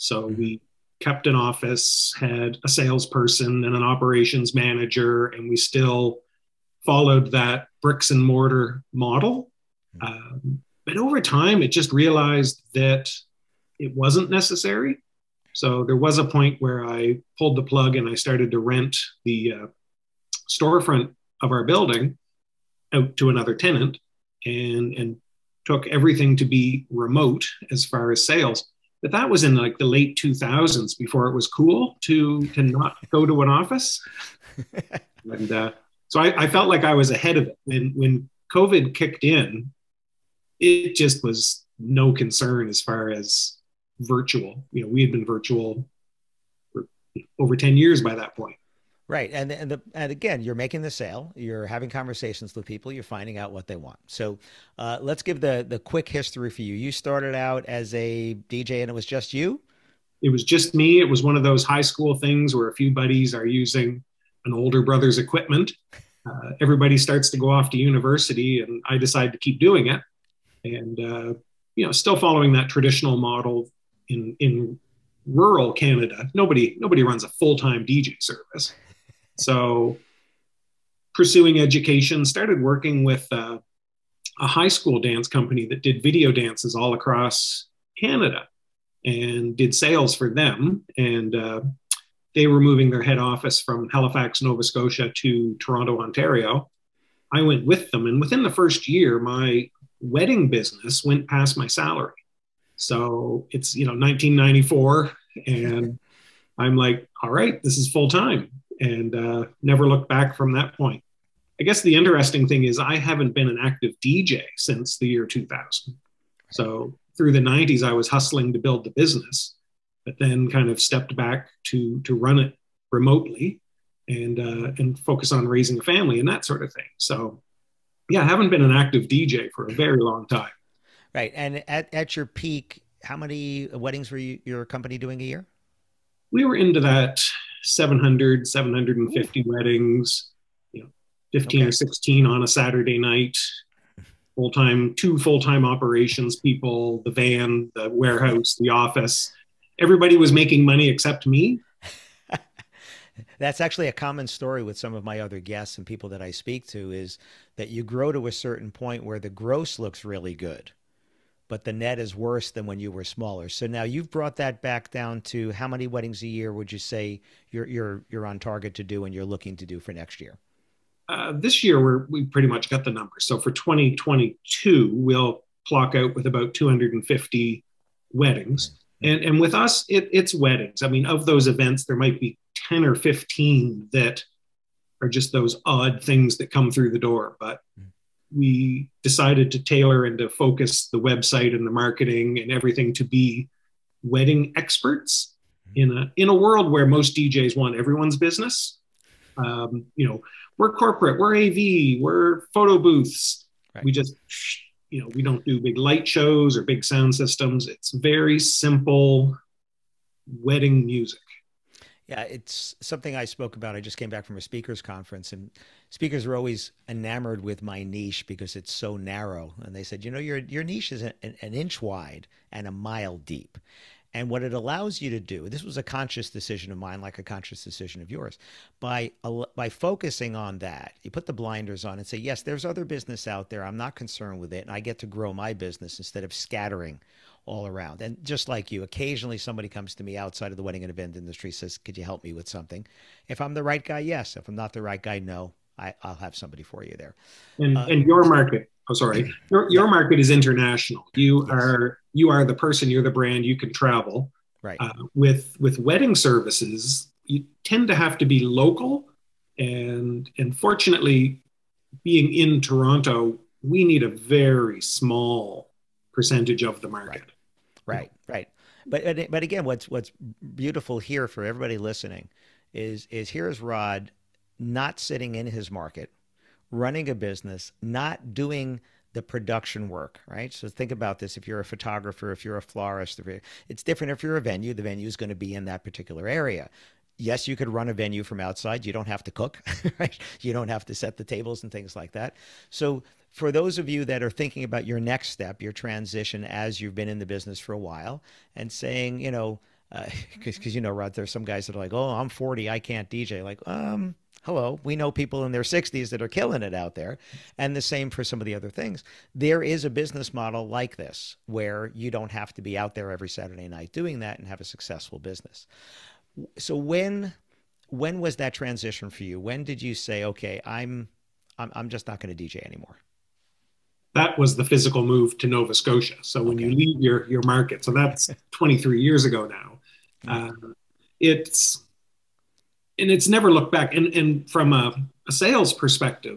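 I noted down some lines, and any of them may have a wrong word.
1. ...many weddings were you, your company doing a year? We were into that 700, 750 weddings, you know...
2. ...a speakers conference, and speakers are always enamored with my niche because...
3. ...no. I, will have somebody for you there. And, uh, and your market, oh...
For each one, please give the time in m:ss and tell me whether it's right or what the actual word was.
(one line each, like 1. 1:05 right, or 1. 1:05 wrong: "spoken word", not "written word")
1. 2:13 right
2. 3:34 right
3. 4:05 right.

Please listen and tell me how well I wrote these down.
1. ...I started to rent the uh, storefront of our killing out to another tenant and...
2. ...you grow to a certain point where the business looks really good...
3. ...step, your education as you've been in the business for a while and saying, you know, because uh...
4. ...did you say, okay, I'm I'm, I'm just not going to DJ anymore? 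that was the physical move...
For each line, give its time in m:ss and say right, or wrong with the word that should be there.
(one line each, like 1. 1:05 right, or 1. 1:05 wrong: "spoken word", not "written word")
1. 0:18 wrong: "building", not "killing"
2. 2:37 wrong: "gross", not "business"
3. 4:55 wrong: "transition", not "education"
4. 5:19 right.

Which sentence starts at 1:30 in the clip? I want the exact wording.
And uh, they were moving their head office from Halifax, Nova Scotia to Toronto, Ontario.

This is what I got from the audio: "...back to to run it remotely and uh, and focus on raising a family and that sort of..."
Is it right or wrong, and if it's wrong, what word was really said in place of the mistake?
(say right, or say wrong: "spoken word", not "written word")
right.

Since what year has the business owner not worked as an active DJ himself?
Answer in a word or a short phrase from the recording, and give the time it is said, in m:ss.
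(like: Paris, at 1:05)
2000, at 1:54.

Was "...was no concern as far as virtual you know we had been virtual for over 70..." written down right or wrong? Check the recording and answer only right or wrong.
wrong.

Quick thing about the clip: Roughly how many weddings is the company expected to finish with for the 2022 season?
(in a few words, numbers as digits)
250.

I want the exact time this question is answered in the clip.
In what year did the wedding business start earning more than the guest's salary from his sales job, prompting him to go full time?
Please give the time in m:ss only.
1:43.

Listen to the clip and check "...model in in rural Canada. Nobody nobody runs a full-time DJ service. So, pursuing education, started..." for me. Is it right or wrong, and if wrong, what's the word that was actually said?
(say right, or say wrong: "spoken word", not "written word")
right.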